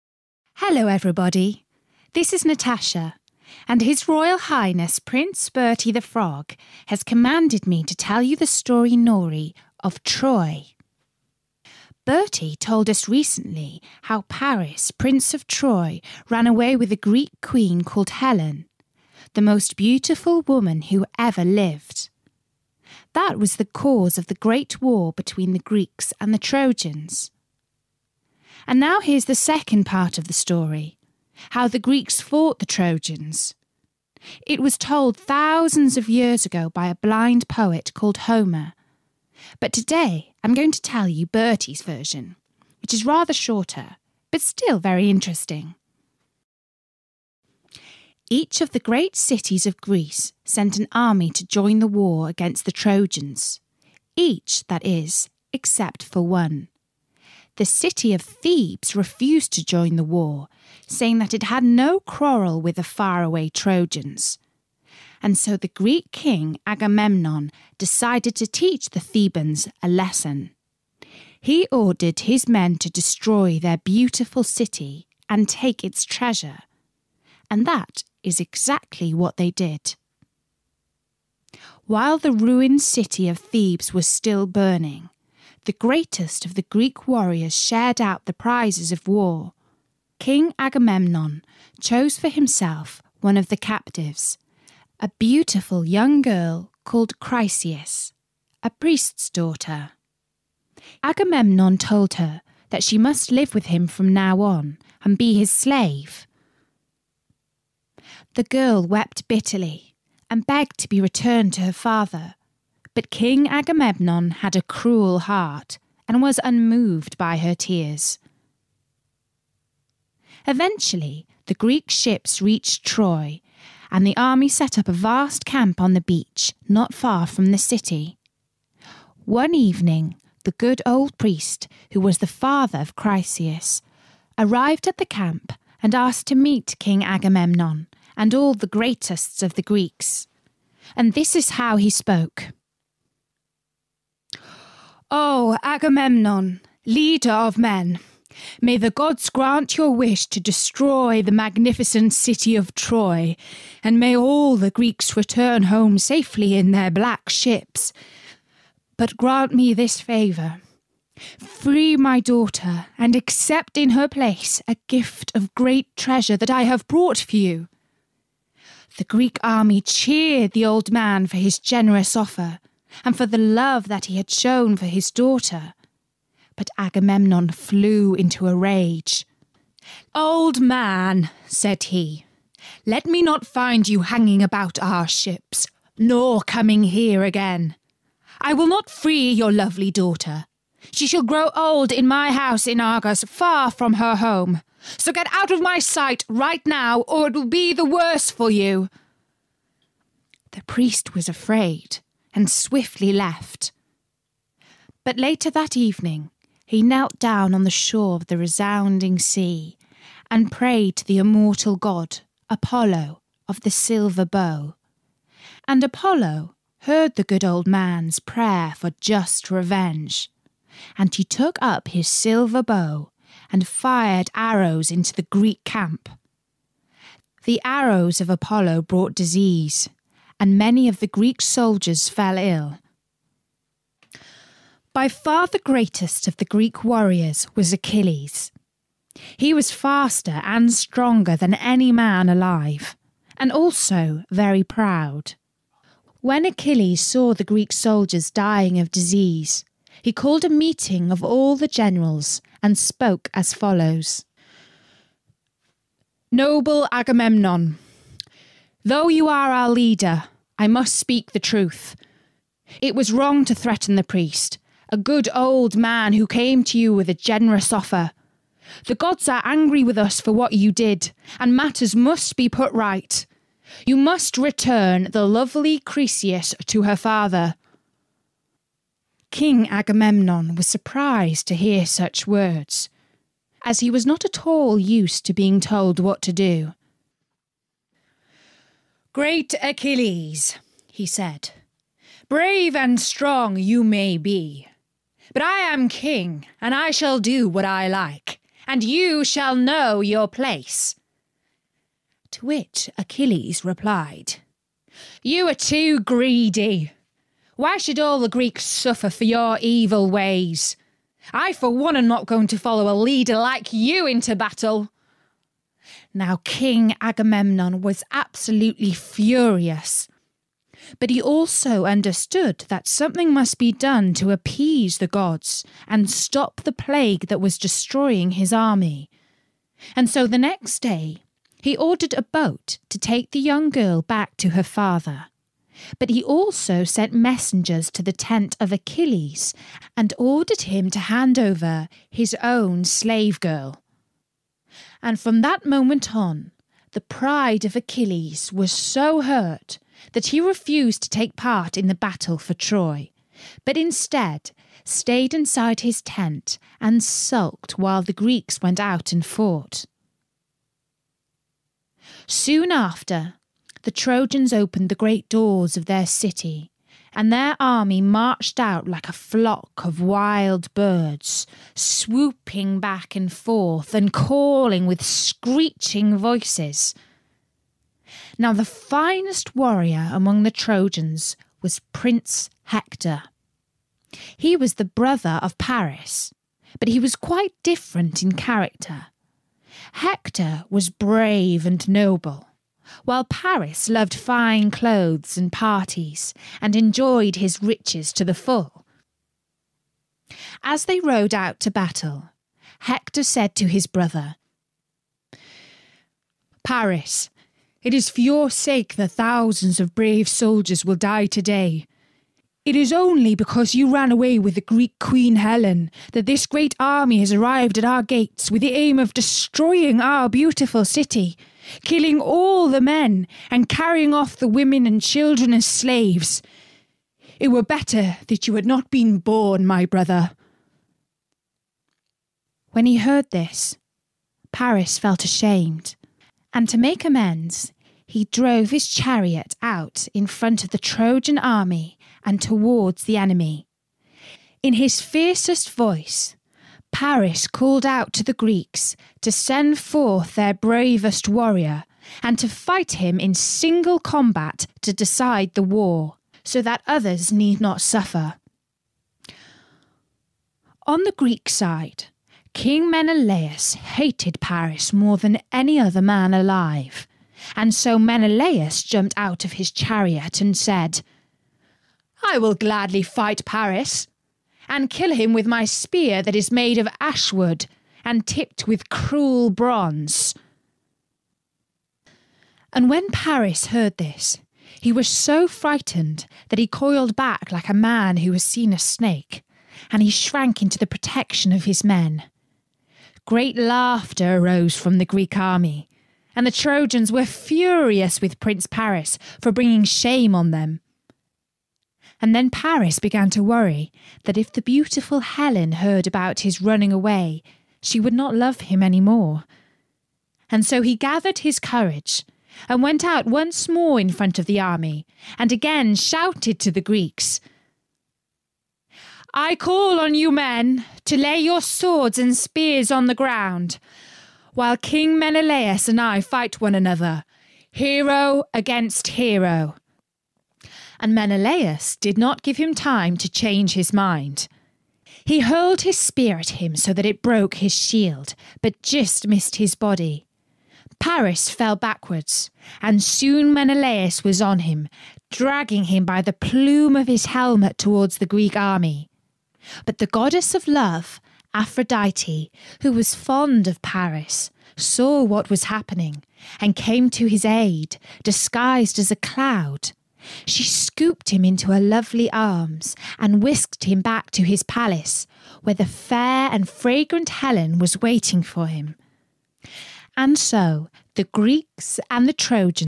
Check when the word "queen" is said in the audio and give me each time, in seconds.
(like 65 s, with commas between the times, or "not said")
17 s, 414 s.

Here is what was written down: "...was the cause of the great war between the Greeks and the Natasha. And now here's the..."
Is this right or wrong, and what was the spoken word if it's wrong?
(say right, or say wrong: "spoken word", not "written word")
wrong: "Trojans", not "Natasha".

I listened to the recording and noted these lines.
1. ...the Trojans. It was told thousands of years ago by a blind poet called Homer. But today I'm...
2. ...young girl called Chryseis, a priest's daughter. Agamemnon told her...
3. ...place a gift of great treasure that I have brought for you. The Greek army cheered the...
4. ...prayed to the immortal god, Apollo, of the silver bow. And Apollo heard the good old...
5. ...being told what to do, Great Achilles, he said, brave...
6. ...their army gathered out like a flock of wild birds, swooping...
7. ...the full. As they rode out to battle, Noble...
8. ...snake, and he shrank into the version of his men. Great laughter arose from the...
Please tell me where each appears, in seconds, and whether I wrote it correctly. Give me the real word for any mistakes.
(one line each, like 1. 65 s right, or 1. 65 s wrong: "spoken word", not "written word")
1. 32 s right
2. 95 s right
3. 164 s right
4. 210 s right
5. 285 s right
6. 367 s wrong: "marched", not "gathered"
7. 398 s wrong: "Hector", not "Noble"
8. 488 s wrong: "protection", not "version".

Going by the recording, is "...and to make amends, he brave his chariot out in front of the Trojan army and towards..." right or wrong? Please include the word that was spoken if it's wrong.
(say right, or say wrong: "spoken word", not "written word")
wrong: "drove", not "brave".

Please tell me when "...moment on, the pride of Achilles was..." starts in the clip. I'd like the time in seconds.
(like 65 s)
345 s.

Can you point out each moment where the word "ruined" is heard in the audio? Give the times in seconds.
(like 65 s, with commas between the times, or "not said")
82 s.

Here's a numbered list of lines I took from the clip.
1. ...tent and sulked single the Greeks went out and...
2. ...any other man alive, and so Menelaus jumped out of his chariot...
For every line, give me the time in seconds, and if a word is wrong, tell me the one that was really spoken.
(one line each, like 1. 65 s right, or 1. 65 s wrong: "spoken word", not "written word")
1. 356 s wrong: "while", not "single"
2. 465 s right.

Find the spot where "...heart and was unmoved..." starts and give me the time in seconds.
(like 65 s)
115 s.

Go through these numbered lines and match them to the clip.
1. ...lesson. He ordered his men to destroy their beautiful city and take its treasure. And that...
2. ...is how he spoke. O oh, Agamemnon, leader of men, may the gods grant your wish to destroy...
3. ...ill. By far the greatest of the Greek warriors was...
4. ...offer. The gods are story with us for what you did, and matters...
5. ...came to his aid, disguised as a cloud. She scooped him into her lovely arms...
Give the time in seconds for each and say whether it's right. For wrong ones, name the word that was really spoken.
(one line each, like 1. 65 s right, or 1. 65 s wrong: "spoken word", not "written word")
1. 69 s right
2. 141 s right
3. 232 s right
4. 267 s wrong: "angry", not "story"
5. 556 s right.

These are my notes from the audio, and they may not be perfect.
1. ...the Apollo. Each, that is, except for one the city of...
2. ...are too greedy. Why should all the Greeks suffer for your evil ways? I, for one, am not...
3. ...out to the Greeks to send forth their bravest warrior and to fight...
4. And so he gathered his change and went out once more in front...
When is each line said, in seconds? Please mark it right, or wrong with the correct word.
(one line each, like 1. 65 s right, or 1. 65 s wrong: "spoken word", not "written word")
1. 52 s wrong: "Trojans", not "Apollo"
2. 305 s right
3. 447 s right
4. 510 s wrong: "courage", not "change".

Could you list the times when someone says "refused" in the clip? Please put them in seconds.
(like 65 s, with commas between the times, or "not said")
58 s, 350 s.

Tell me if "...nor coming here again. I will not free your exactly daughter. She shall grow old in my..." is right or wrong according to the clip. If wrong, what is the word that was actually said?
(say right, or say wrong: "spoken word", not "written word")
wrong: "lovely", not "exactly".